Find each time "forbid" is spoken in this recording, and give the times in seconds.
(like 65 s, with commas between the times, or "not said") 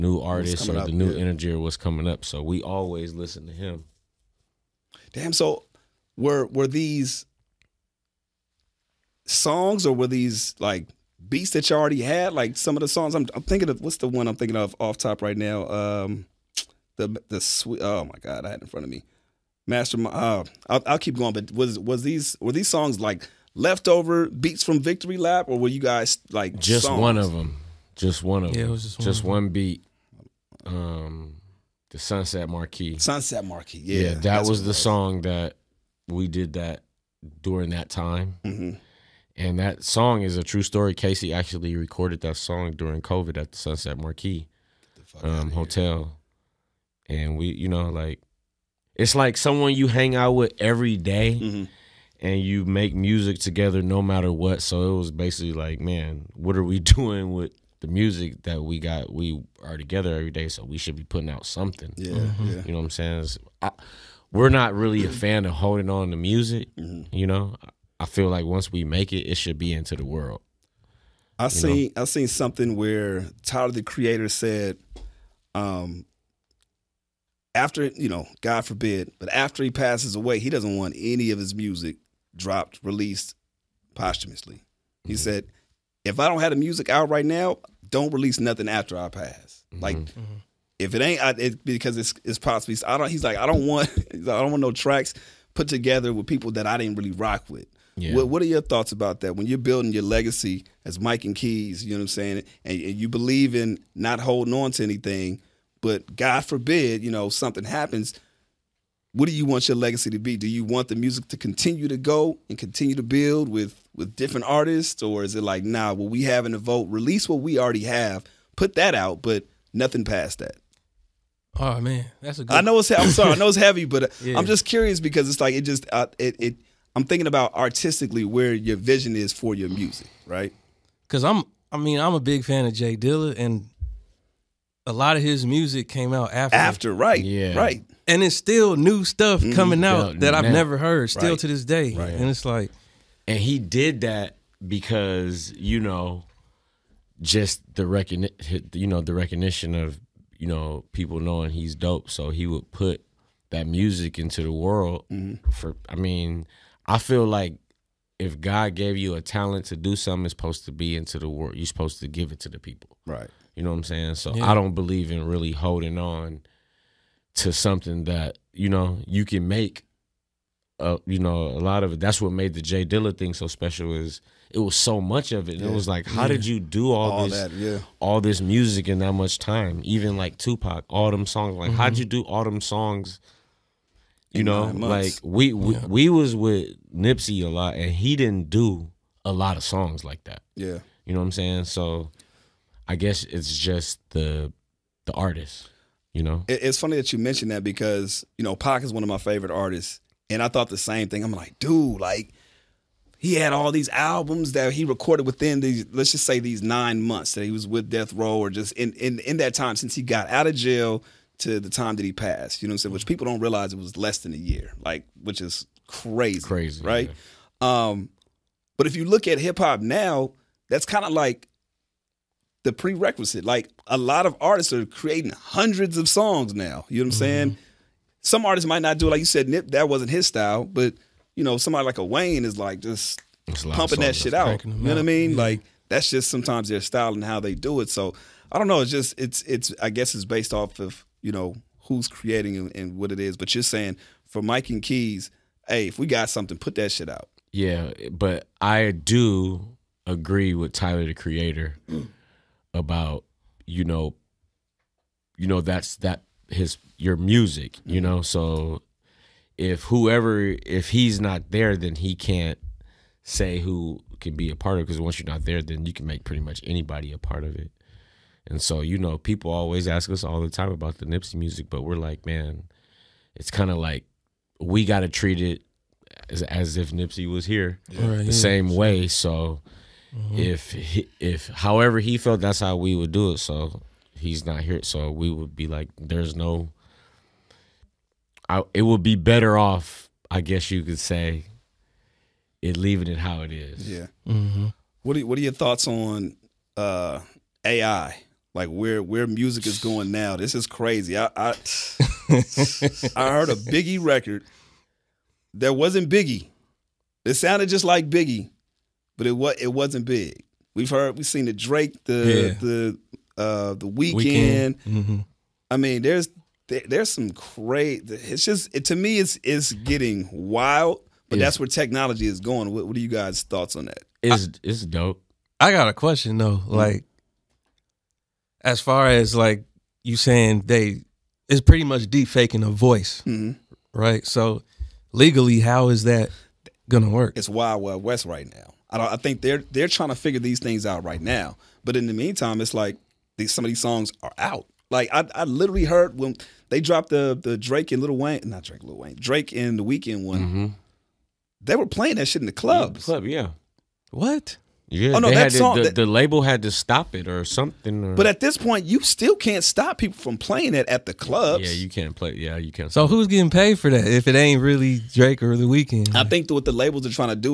78 s, 106 s.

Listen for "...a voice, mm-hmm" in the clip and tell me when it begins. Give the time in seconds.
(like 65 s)
332 s.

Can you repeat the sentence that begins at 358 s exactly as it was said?
Or, but at this point, you still can't stop people from playing it at the clubs.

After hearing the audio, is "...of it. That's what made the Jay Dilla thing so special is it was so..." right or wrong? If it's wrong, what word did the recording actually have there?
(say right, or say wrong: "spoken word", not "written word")
right.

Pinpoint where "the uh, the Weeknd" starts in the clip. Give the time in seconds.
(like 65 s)
312 s.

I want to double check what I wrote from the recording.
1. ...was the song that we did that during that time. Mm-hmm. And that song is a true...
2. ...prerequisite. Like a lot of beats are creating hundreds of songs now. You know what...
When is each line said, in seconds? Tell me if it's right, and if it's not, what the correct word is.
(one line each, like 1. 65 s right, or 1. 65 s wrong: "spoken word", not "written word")
1. 34 s right
2. 222 s wrong: "artists", not "beats".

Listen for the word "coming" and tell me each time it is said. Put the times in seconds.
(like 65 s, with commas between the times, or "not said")
1 s, 139 s.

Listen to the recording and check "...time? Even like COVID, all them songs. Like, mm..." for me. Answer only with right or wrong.
wrong.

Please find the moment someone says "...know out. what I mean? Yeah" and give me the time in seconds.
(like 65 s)
234 s.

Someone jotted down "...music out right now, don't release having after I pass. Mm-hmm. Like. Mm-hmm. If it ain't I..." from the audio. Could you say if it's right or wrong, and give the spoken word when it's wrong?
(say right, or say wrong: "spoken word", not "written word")
wrong: "nothing", not "having".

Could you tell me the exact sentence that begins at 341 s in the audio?
But in the meantime, it's like these, some of these songs are out.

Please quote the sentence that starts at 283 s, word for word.
So he's not here, so we would be like, there's no.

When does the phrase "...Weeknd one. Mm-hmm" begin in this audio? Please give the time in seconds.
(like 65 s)
349 s.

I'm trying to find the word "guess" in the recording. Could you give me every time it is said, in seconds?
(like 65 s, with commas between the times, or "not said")
192 s, 239 s, 290 s.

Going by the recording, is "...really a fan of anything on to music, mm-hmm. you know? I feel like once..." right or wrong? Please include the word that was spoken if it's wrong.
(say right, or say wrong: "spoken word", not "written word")
wrong: "holding", not "anything".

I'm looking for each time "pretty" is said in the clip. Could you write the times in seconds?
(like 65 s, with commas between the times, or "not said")
266 s, 331 s.